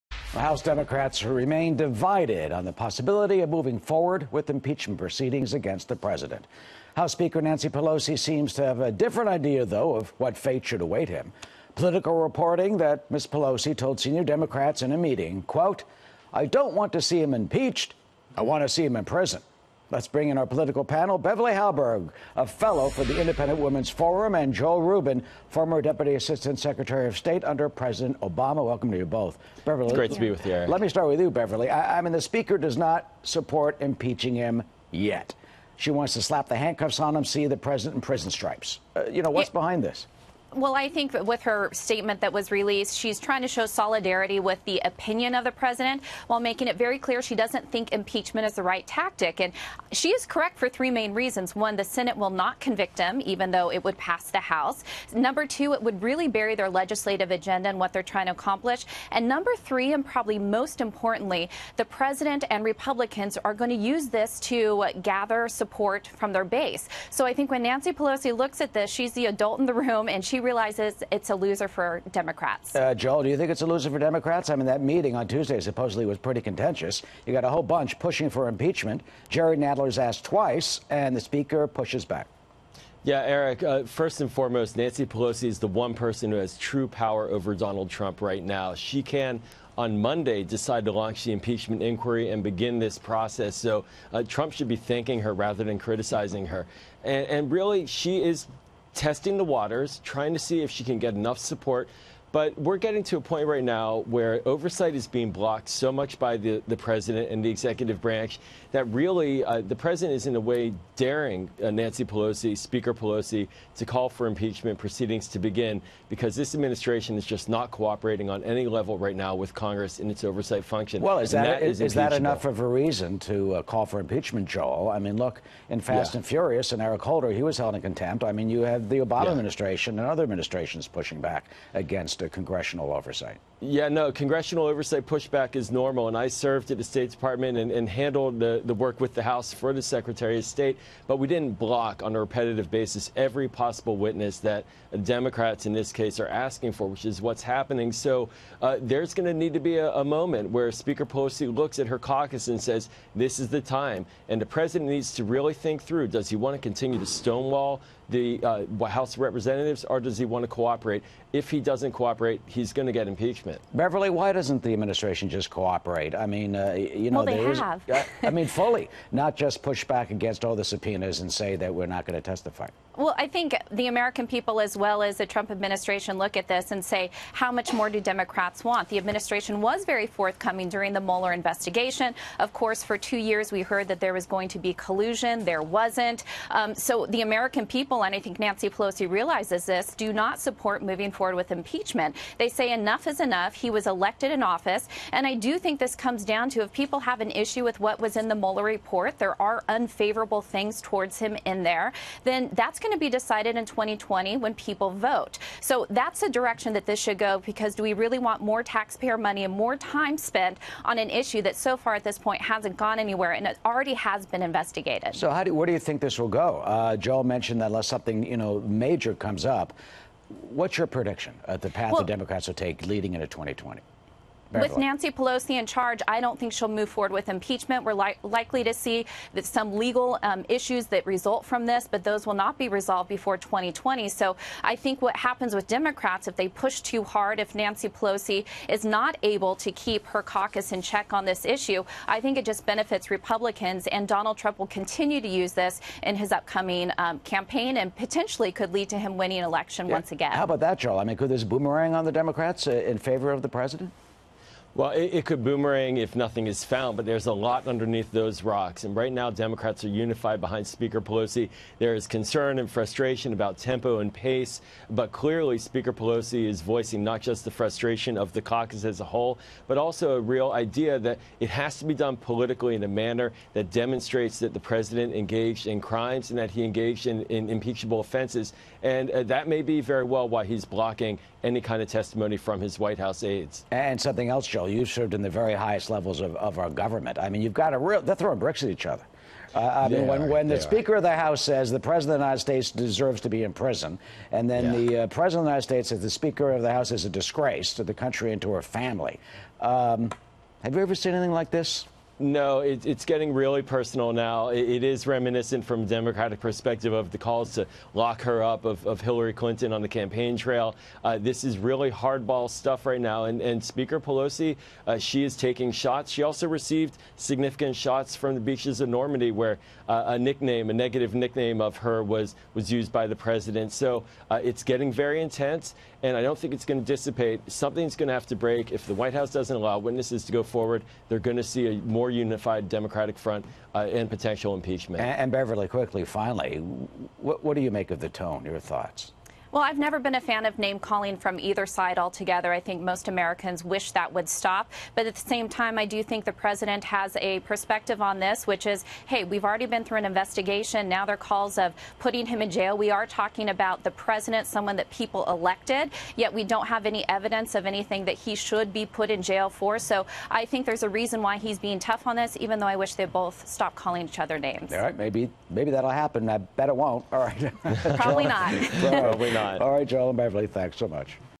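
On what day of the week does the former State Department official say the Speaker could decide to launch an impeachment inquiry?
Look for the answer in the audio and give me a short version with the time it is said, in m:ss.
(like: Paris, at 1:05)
Monday, at 1:29.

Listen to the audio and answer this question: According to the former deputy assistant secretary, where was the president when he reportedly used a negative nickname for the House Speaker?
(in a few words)
Normandy.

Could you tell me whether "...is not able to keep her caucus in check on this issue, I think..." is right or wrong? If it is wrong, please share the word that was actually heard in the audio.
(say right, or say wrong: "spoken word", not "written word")
right.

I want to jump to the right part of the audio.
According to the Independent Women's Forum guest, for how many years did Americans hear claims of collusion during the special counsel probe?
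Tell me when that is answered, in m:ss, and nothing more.
3:02.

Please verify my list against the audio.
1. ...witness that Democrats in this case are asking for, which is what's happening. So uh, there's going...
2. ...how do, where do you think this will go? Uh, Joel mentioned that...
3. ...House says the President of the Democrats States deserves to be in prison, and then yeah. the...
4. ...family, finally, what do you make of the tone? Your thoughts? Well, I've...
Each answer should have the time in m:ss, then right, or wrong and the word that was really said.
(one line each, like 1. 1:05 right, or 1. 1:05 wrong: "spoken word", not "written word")
1. 2:23 right
2. 3:35 right
3. 4:51 wrong: "United", not "Democrats"
4. 5:35 wrong: "quickly", not "family".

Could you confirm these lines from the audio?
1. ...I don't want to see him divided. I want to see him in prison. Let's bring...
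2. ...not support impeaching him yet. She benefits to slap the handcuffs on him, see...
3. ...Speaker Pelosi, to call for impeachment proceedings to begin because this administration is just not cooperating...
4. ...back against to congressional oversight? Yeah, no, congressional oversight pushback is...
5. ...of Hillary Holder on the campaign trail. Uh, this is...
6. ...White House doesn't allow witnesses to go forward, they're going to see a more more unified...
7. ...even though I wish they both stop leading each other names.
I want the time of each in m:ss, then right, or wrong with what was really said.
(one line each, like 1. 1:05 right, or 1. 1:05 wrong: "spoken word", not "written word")
1. 0:16 wrong: "impeached", not "divided"
2. 0:32 wrong: "wants", not "benefits"
3. 1:52 right
4. 2:11 right
5. 5:08 wrong: "Clinton", not "Holder"
6. 5:28 right
7. 6:02 wrong: "calling", not "leading".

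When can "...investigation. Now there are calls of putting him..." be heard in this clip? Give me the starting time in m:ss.
5:50.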